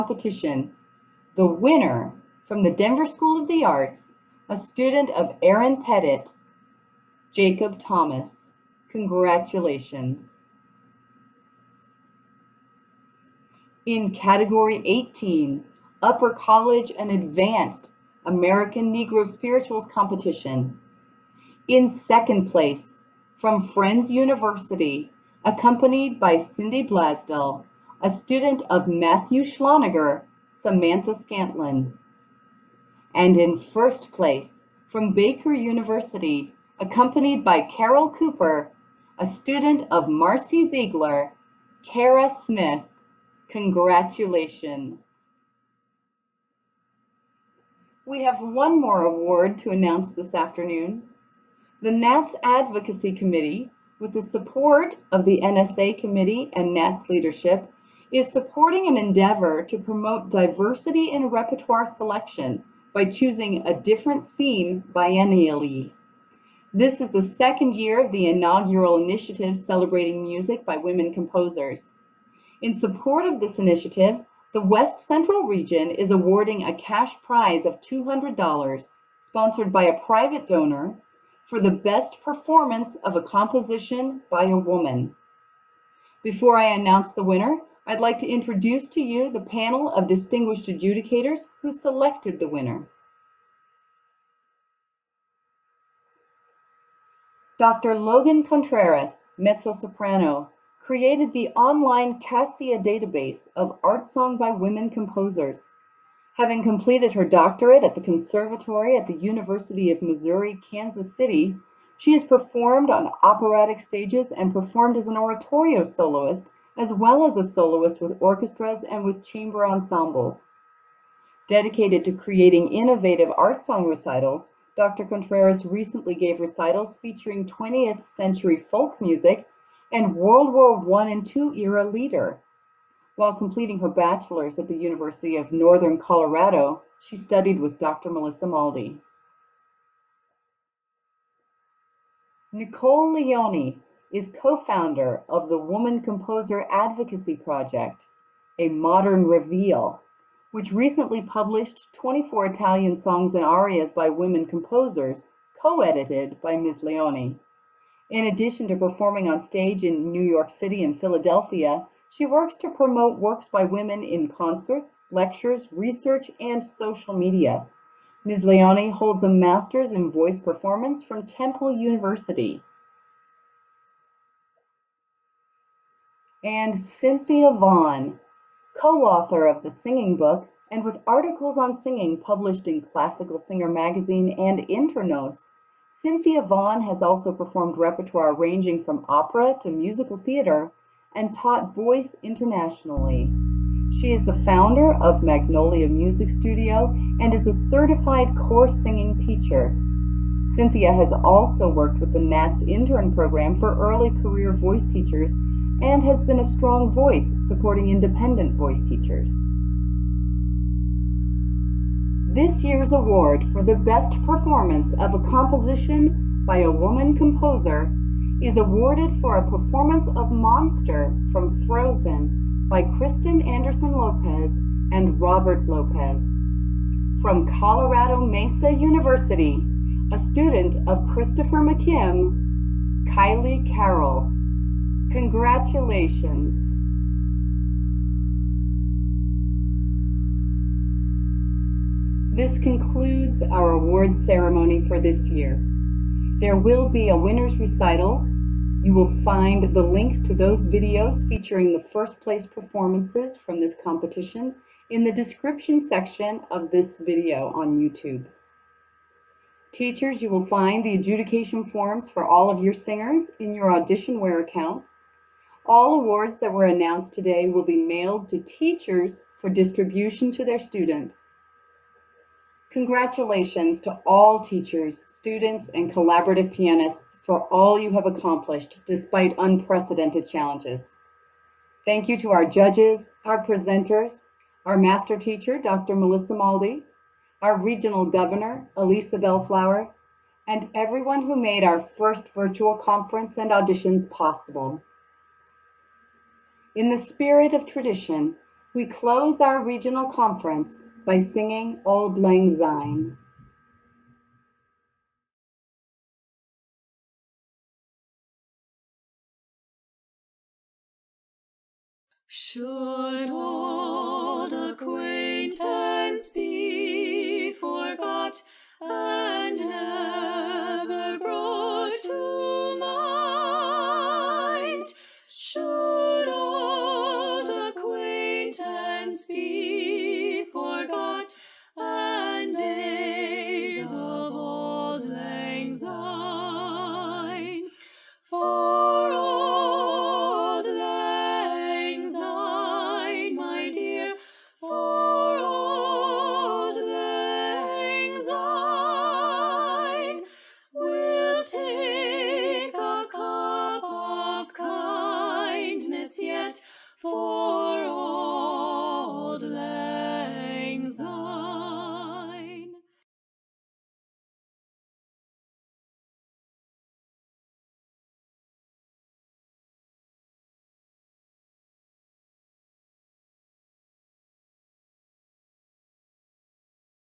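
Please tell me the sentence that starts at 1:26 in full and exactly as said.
Before I announce the winner, I'd like to introduce to you the panel of distinguished adjudicators who selected the winner.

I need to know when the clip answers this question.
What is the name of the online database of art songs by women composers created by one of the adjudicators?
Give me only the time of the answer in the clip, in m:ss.
1:42.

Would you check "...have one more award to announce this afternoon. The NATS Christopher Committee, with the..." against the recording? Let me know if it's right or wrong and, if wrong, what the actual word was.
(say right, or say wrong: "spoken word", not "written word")
wrong: "Advocacy", not "Christopher".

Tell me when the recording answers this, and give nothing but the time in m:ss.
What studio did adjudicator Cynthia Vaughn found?
3:15.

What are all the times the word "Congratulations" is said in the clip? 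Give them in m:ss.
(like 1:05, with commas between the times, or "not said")
0:08, 0:43, 3:55, 4:32.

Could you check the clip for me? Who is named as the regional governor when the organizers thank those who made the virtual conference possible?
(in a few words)
Alisa Belflower.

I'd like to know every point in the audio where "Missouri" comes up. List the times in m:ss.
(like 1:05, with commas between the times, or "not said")
1:50.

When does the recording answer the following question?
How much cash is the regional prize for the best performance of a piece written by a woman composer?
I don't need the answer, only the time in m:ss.
1:17.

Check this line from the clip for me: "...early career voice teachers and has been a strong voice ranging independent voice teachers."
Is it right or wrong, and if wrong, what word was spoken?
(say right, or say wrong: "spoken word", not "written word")
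wrong: "supporting", not "ranging".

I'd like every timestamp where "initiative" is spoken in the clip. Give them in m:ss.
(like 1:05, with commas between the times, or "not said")
1:08, 1:13.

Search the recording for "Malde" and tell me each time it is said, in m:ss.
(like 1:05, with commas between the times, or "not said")
2:18, 4:46.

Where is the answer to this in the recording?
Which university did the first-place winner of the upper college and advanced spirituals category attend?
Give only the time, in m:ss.
0:35.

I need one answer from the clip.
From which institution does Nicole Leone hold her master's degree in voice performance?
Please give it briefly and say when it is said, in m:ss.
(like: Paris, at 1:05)
Temple University, at 2:51.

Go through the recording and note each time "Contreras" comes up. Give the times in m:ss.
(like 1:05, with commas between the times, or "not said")
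1:38, 2:05.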